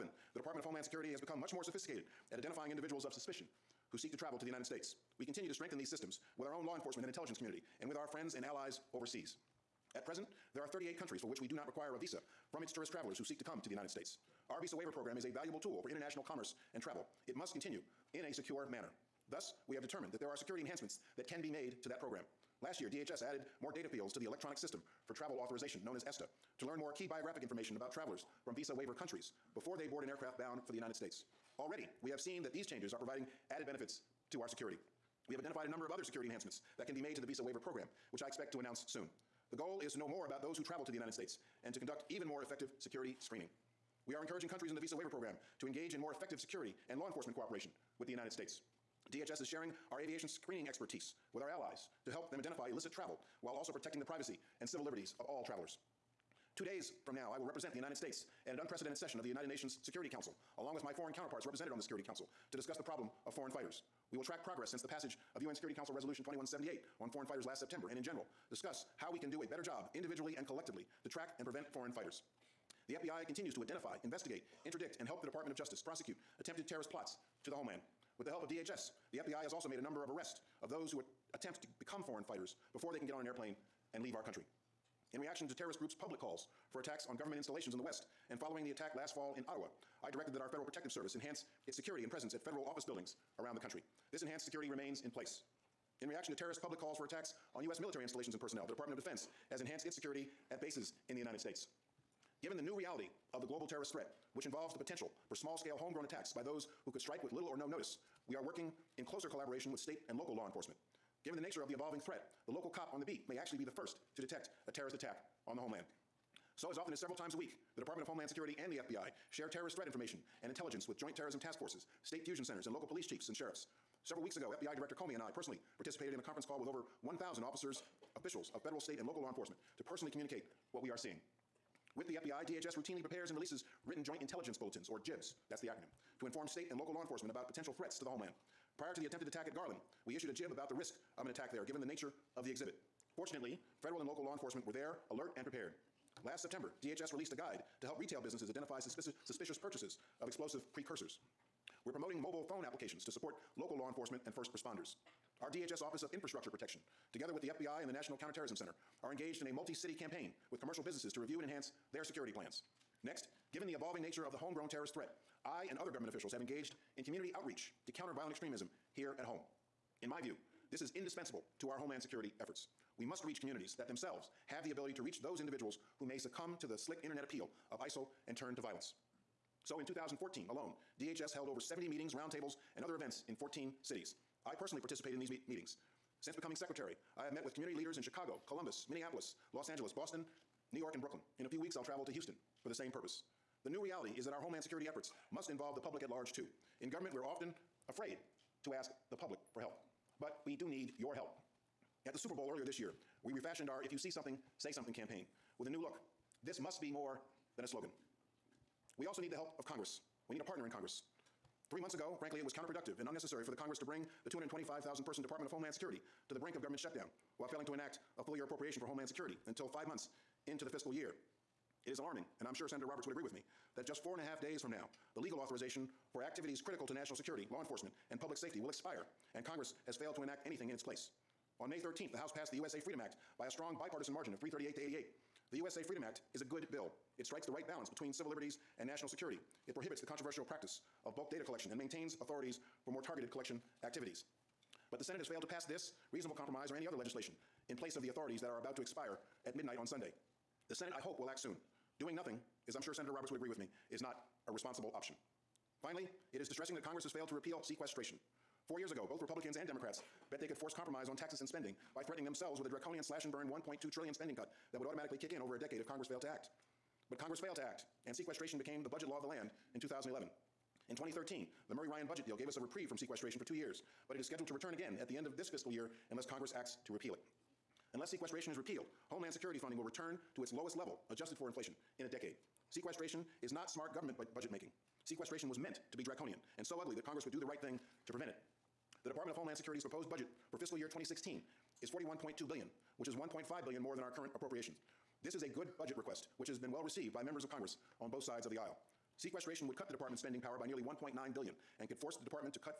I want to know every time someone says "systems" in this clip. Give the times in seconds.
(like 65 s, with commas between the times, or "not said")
5 s, 24 s.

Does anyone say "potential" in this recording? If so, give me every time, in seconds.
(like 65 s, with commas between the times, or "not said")
104 s, 137 s.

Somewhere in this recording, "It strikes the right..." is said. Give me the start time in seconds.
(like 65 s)
237 s.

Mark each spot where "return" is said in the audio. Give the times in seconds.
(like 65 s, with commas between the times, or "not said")
274 s, 279 s.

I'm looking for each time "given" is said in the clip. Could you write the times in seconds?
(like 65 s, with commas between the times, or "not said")
102 s, 111 s, 141 s, 163 s.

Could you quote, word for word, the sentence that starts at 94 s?
This enhanced security remains in place.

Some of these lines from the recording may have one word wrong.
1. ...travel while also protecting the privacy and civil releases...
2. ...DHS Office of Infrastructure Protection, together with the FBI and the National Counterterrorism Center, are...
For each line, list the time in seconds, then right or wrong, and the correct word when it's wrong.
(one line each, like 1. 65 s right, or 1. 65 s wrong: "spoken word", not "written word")
1. 52 s wrong: "liberties", not "releases"
2. 155 s right.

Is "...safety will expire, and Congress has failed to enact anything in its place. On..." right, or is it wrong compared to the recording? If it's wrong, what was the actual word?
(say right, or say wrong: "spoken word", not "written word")
right.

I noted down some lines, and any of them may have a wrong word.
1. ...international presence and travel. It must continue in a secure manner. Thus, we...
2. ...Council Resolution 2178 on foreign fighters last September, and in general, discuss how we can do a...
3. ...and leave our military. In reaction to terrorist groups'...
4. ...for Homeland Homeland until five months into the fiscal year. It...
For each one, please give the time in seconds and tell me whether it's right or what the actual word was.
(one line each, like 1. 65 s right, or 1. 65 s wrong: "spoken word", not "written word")
1. 15 s wrong: "commerce", not "presence"
2. 65 s right
3. 83 s wrong: "country", not "military"
4. 218 s wrong: "Security", not "Homeland".